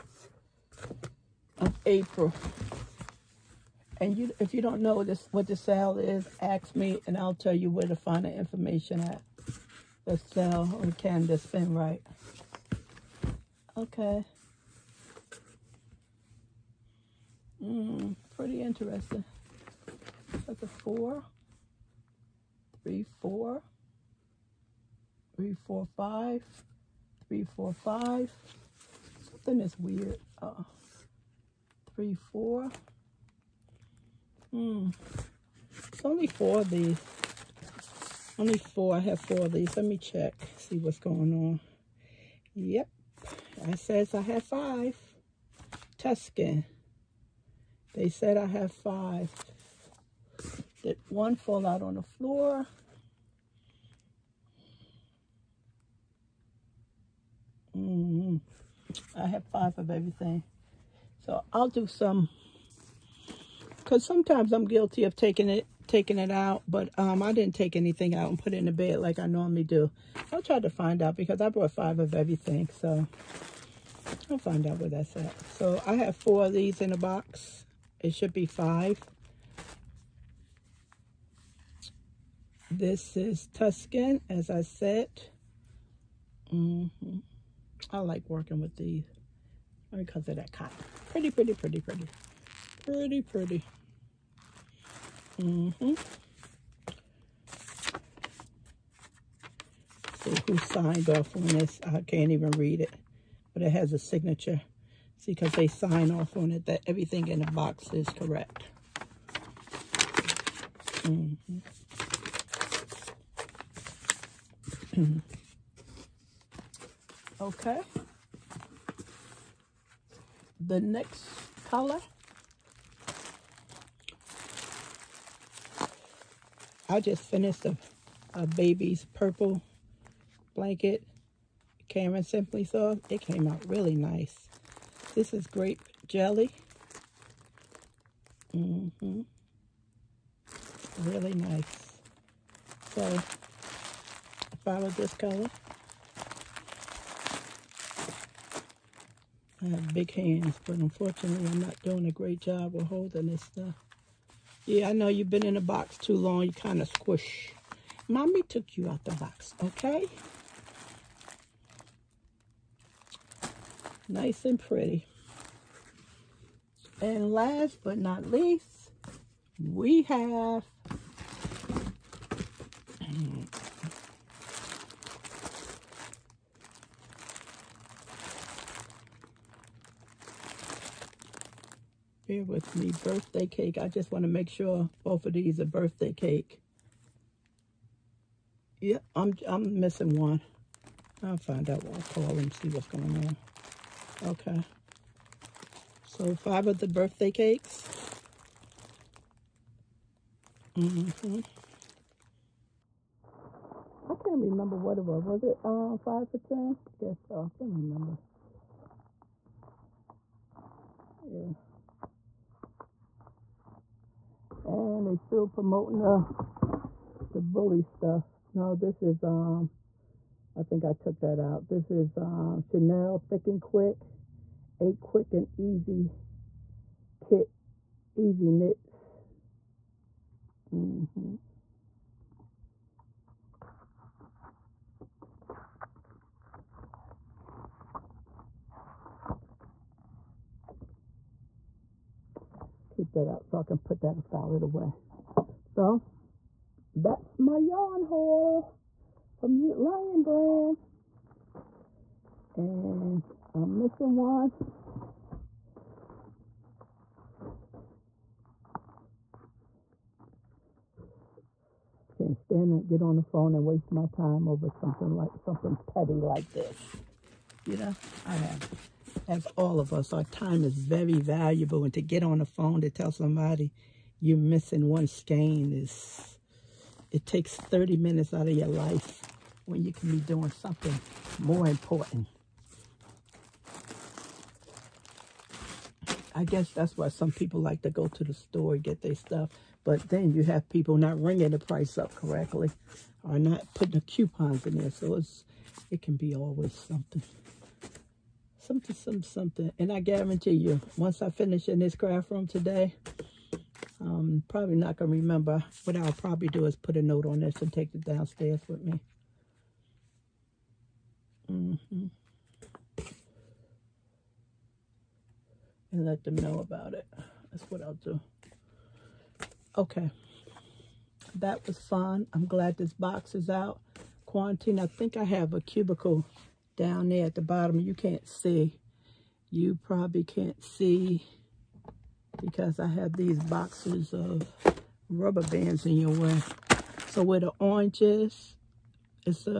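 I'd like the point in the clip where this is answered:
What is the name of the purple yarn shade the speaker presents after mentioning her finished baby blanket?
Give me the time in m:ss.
2:15.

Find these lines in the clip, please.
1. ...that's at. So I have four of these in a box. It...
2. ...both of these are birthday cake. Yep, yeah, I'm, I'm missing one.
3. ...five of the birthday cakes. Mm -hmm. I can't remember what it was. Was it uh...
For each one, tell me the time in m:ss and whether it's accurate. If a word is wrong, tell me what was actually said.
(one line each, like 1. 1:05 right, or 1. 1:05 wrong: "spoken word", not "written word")
1. 1:14 right
2. 3:05 right
3. 3:16 right.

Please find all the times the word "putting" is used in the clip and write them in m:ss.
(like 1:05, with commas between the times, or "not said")
4:53.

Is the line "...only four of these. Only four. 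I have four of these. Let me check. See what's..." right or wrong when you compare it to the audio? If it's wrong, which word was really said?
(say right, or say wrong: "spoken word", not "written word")
right.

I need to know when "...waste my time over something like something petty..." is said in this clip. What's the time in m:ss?
4:23.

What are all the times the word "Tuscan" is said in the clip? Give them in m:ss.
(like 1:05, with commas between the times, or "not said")
0:45, 1:23.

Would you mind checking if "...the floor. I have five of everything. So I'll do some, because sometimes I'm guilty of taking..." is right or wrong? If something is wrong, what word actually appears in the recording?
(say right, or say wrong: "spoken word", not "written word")
right.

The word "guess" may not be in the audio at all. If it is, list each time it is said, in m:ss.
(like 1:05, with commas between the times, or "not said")
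3:26, 4:46.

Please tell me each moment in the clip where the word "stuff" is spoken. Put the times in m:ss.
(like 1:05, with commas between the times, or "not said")
2:33, 3:37, 4:49.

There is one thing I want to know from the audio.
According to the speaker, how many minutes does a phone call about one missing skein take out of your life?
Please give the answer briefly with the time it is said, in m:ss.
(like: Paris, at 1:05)
30, at 4:37.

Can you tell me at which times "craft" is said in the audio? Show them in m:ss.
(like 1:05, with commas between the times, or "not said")
5:01.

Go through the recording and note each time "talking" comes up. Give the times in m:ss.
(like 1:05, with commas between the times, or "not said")
not said.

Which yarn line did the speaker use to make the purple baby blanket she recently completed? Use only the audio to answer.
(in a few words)
Caron Simply Soft.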